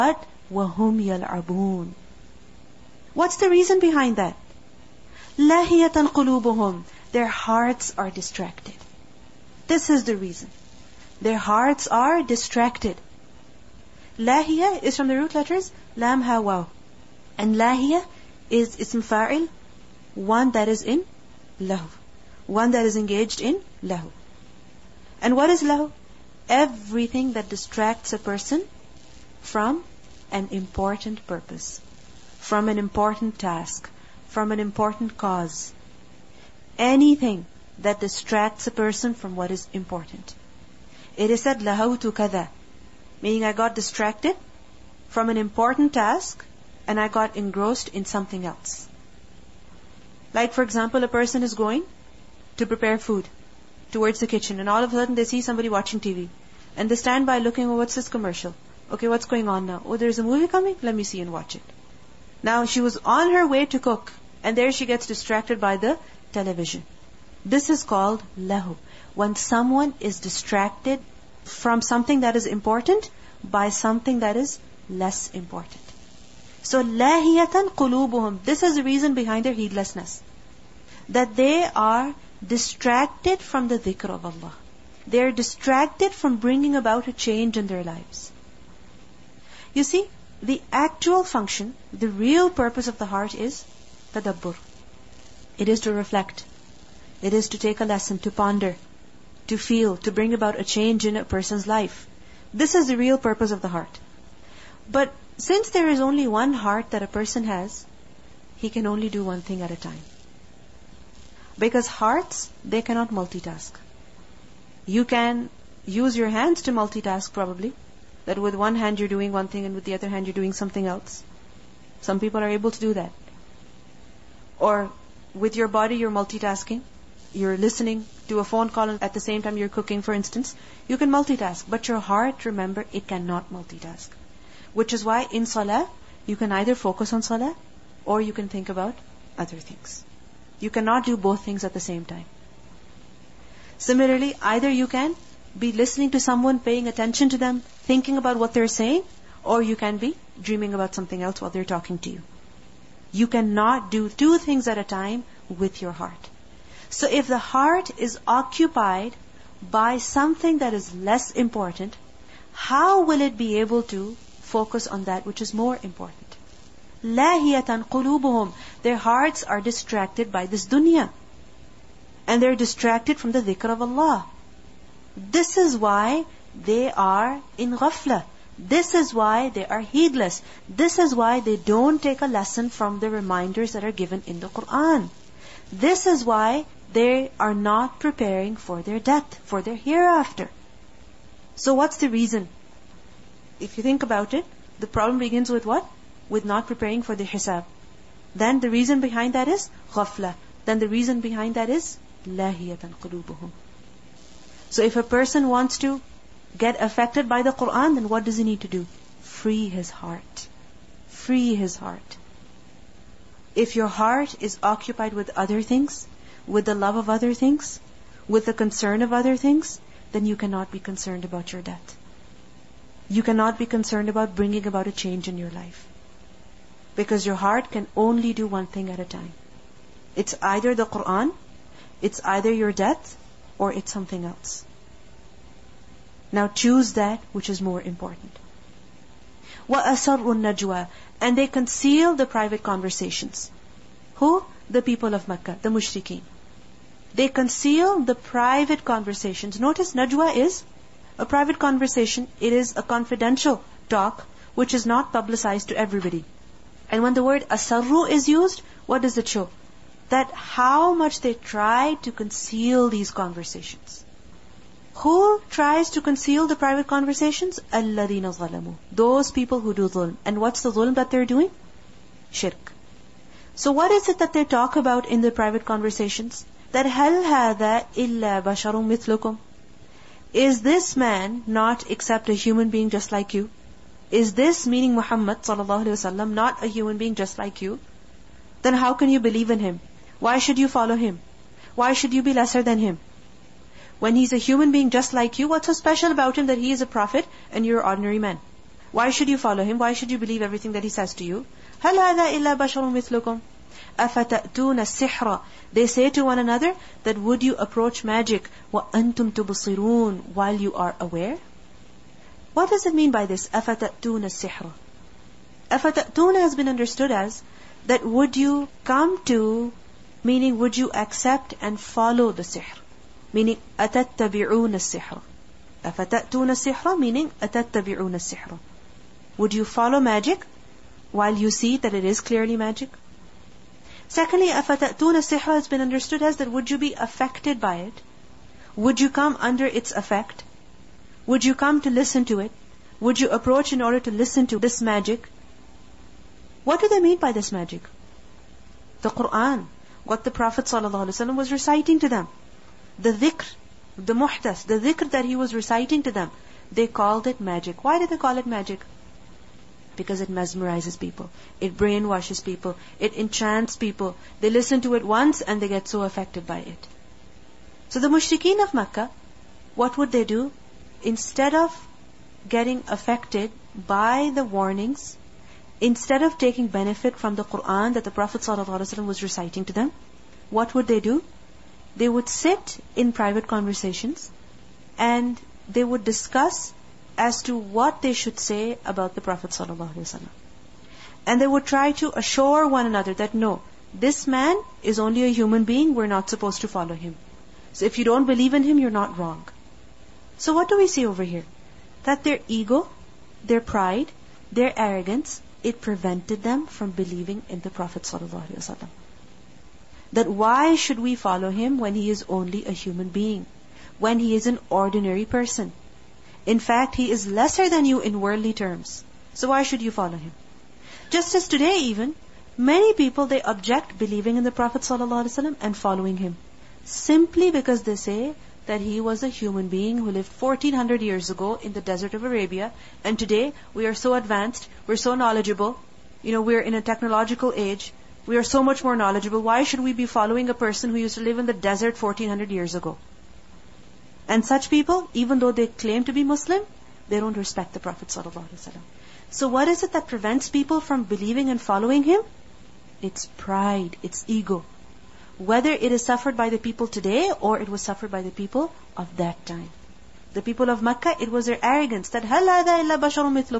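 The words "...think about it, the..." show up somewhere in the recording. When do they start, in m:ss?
3:13.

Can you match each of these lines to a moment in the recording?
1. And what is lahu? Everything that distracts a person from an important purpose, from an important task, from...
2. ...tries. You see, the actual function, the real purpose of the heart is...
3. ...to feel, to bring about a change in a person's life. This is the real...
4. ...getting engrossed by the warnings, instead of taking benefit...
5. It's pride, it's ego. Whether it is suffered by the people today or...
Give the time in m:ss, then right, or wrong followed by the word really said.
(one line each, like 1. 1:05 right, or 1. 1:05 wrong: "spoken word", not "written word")
1. 0:25 right
2. 1:27 wrong: "lives", not "tries"
3. 1:39 right
4. 6:12 wrong: "affected", not "engrossed"
5. 7:33 right.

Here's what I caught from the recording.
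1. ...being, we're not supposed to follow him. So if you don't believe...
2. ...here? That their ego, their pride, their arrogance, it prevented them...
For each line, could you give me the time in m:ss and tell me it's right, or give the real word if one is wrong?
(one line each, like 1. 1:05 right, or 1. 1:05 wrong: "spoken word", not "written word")
1. 6:35 right
2. 6:41 right.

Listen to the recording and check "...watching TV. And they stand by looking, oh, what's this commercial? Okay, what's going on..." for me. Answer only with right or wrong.
right.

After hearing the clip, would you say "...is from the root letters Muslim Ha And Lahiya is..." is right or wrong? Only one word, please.
wrong.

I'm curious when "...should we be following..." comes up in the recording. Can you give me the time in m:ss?
7:19.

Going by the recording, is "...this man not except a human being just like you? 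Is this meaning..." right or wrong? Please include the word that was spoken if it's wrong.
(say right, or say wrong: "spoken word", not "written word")
right.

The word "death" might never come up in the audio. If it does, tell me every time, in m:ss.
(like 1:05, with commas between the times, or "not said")
3:09, 3:41, 3:52.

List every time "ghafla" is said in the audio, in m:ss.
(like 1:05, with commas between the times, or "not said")
2:57, 3:19.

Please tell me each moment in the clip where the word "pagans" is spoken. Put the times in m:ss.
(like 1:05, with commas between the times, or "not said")
not said.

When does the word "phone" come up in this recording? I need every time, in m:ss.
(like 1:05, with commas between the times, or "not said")
2:08.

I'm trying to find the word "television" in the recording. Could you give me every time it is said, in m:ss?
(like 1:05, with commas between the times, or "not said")
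1:06.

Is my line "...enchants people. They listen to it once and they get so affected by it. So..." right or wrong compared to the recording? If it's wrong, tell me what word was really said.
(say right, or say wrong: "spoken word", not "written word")
right.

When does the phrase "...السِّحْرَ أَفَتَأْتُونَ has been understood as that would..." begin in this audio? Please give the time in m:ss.
5:14.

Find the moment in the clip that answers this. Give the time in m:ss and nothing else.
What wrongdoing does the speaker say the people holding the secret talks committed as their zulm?
4:32.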